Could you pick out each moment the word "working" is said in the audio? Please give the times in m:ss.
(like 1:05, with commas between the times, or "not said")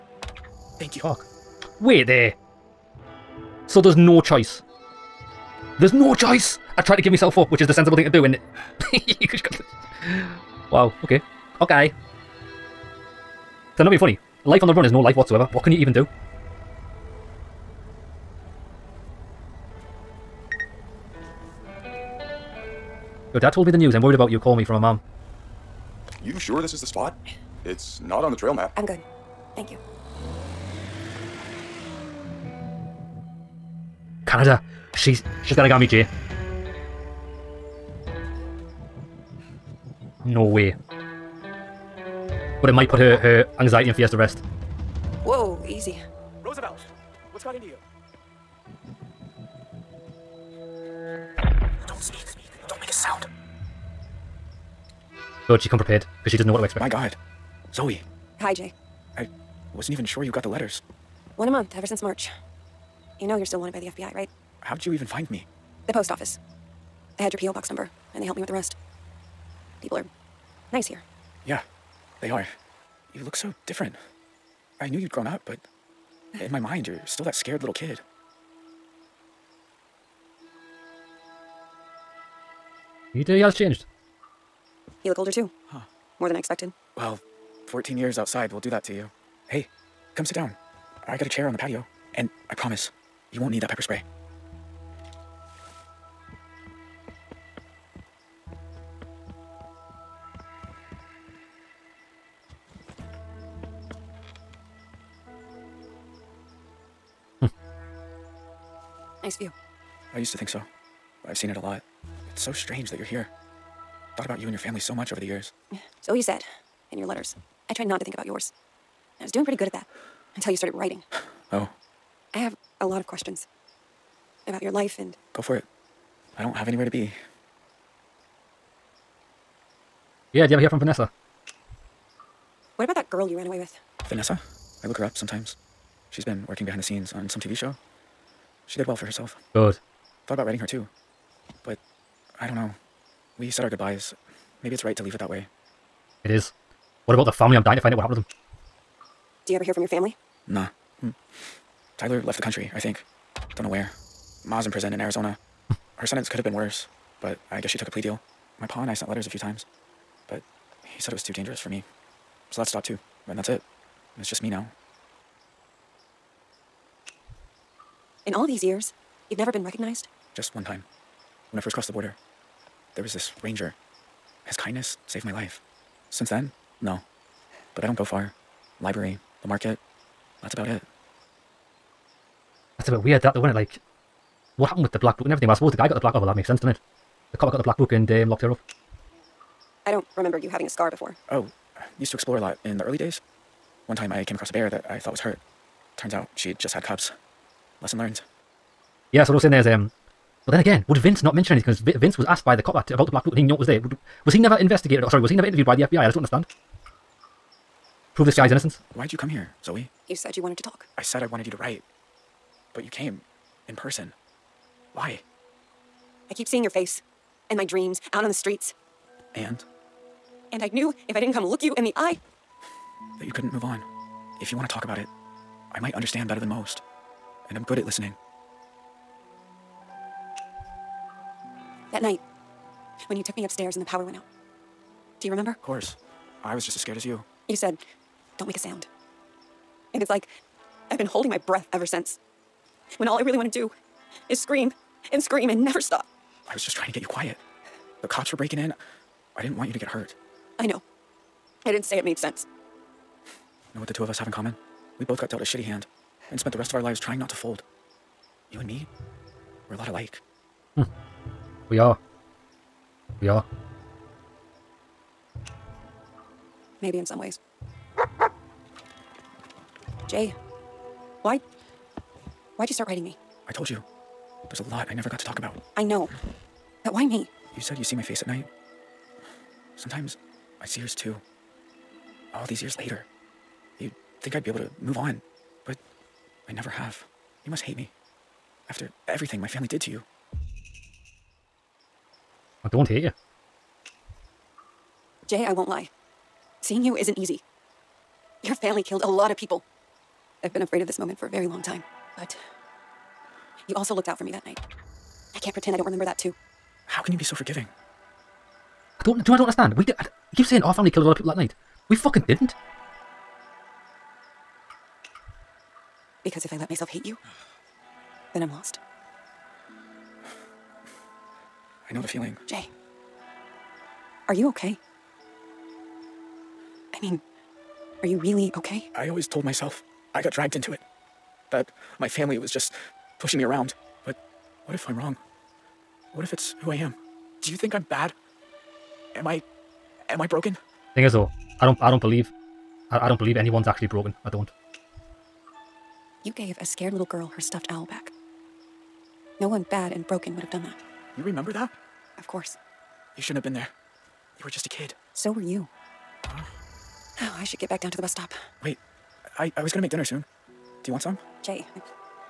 2:16.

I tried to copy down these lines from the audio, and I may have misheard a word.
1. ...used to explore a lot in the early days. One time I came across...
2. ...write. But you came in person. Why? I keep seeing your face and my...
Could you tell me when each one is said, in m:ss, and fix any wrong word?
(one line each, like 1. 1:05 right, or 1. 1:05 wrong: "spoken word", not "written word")
1. 3:11 right
2. 3:31 right.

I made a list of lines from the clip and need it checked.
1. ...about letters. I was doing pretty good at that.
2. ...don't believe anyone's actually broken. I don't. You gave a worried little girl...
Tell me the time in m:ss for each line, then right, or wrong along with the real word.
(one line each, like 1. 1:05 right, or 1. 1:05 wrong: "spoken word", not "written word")
1. 1:58 wrong: "yours", not "letters"
2. 5:43 wrong: "scared", not "worried".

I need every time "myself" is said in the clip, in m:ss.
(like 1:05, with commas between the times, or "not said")
0:07, 5:16, 5:29.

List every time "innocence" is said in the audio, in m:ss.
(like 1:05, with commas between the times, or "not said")
3:28.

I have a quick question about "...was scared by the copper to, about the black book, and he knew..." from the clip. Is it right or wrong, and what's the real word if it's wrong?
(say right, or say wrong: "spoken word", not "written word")
wrong: "asked", not "scared".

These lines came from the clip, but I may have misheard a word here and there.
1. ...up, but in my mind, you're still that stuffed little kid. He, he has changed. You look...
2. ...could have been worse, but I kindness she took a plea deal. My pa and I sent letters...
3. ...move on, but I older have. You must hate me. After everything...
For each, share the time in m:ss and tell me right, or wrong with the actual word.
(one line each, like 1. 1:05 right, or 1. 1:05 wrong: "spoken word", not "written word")
1. 1:15 wrong: "scared", not "stuffed"
2. 2:36 wrong: "guess", not "kindness"
3. 4:44 wrong: "never", not "older".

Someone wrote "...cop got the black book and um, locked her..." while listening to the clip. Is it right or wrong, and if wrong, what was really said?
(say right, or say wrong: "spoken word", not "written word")
right.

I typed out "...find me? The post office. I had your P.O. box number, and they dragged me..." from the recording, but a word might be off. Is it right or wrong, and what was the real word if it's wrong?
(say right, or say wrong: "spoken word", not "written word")
wrong: "helped", not "dragged".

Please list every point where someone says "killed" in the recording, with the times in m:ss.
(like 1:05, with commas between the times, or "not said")
4:58, 5:10.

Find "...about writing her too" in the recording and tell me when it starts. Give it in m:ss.
2:20.